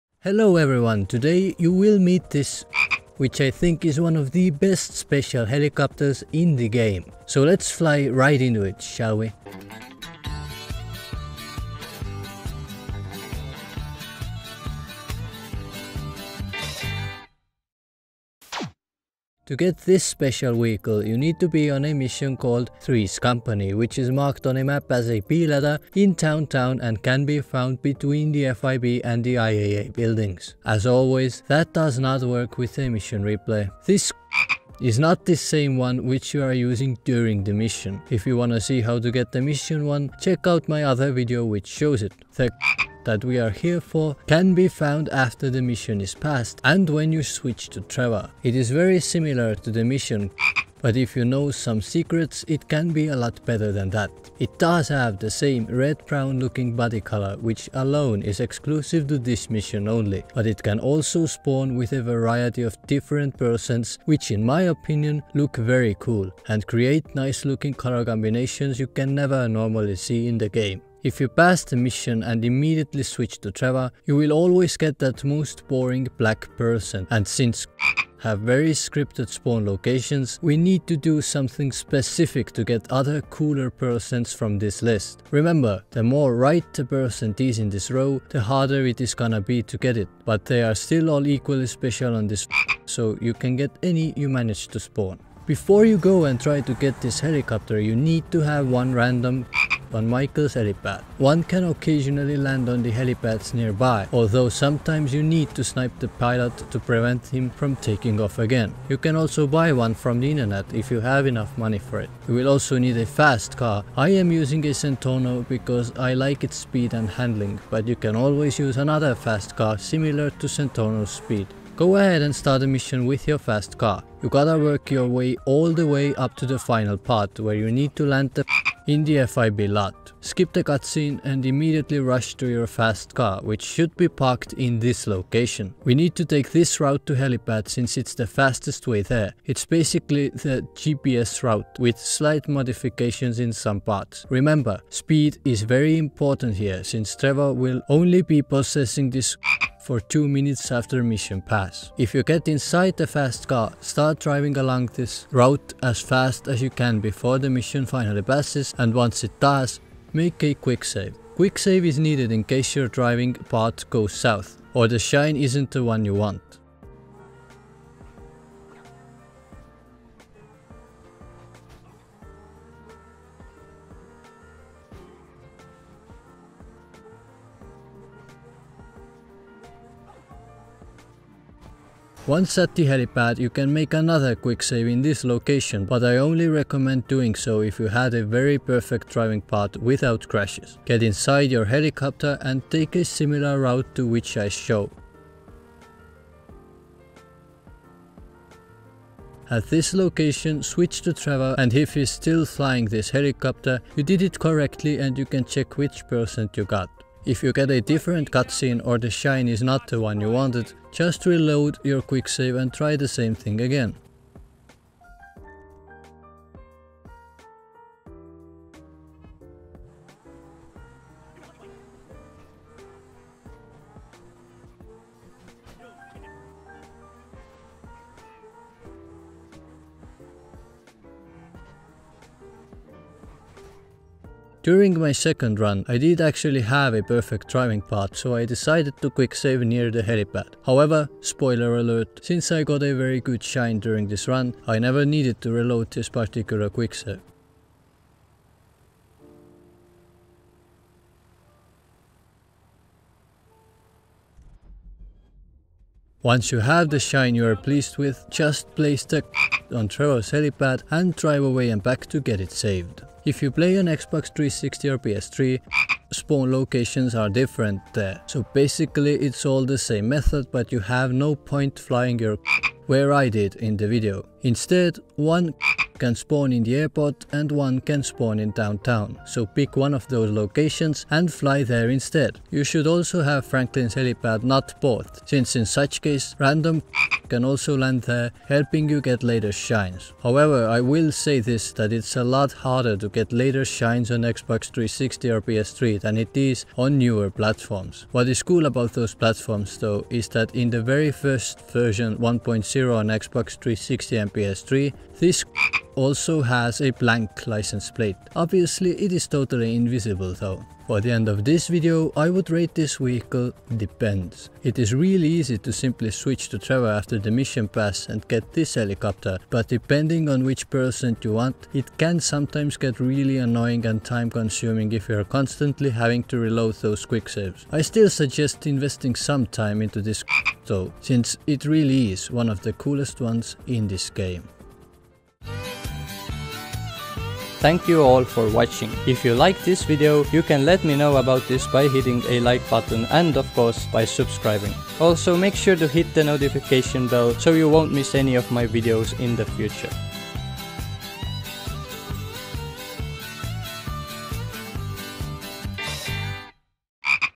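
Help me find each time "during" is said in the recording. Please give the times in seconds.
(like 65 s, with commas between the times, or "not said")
37 s, 234 s, 243 s.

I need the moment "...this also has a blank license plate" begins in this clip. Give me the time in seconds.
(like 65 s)
305 s.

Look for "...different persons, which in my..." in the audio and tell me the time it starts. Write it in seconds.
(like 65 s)
62 s.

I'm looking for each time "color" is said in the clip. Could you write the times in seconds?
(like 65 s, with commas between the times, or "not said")
57 s, 67 s.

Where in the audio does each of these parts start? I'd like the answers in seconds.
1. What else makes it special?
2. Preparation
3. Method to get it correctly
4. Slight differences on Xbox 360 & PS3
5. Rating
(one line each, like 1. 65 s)
1. 48 s
2. 95 s
3. 121 s
4. 263 s
5. 310 s.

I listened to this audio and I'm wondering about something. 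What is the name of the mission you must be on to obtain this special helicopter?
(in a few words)
Three's Company.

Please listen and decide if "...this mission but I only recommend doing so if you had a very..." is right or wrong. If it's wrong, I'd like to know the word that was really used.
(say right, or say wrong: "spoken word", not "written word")
wrong: "location", not "mission".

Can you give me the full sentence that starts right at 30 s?
As always, that does not work with a mission replay.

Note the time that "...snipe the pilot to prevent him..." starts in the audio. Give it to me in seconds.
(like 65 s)
105 s.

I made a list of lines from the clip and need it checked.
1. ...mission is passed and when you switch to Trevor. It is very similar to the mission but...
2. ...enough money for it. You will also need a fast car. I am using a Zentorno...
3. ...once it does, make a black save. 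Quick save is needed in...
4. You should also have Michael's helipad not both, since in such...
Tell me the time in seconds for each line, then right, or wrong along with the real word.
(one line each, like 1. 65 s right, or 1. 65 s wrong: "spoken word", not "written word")
1. 45 s right
2. 111 s right
3. 158 s wrong: "quick", not "black"
4. 282 s wrong: "Franklin", not "Michael".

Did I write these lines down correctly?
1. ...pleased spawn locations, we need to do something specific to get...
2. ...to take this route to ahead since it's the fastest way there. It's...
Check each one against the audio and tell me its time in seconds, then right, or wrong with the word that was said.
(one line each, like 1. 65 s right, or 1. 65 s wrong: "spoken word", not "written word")
1. 78 s wrong: "scripted", not "pleased"
2. 136 s wrong: "helipad", not "ahead".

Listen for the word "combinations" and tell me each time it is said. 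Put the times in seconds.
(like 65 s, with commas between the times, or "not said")
68 s.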